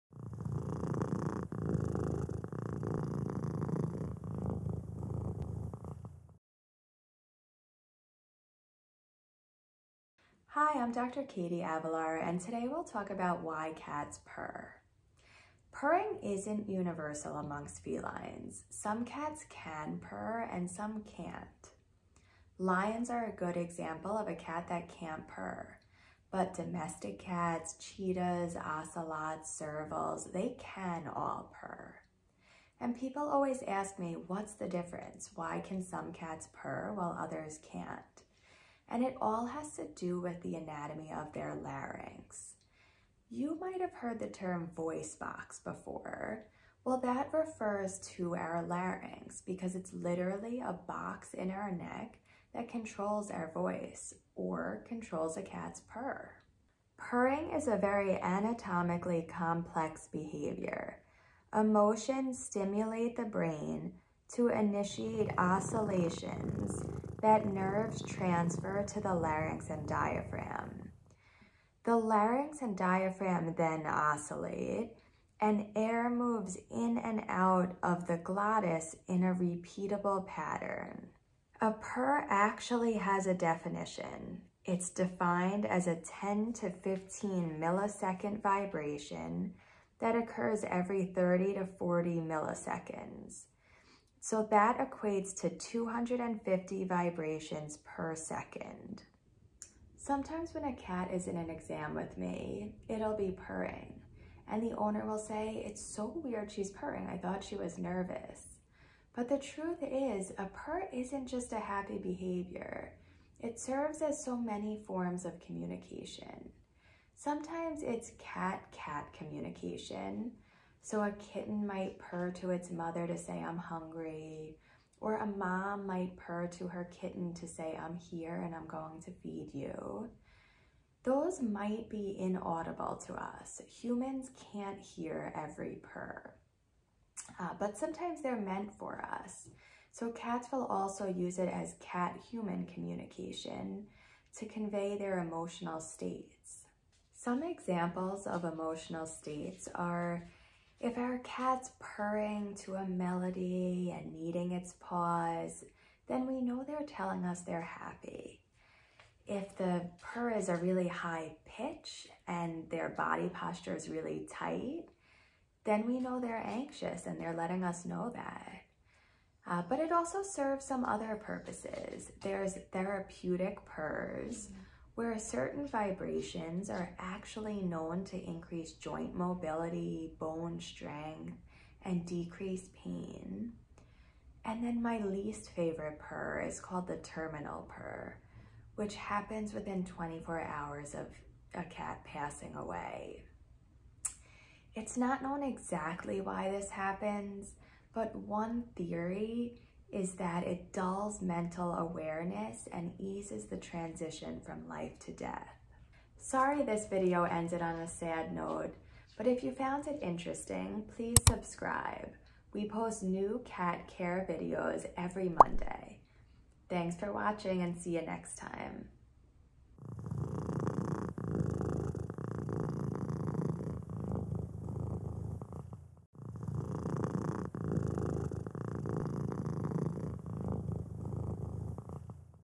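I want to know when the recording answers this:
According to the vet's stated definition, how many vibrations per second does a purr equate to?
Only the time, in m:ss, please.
1:35.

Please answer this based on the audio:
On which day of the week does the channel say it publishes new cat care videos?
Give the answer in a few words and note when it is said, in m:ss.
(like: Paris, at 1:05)
Monday, at 3:35.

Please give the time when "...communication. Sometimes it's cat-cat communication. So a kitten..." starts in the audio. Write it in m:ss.
1:55.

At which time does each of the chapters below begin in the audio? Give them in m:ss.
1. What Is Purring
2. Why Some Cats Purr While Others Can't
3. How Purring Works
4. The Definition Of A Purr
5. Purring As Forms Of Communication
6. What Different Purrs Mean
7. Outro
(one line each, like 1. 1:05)
1. 0:10
2. 0:35
3. 0:56
4. 1:20
5. 1:50
6. 2:30
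7. 3:30.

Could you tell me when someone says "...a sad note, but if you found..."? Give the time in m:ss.
3:27.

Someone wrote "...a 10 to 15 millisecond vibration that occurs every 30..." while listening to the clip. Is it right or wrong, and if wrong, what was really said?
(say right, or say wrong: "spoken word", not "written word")
right.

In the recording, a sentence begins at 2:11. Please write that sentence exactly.
Those might be inaudible to us.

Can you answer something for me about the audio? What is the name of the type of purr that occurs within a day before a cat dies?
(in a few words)
terminal purr.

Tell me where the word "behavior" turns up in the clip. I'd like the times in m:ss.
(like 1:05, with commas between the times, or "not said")
1:00, 1:51.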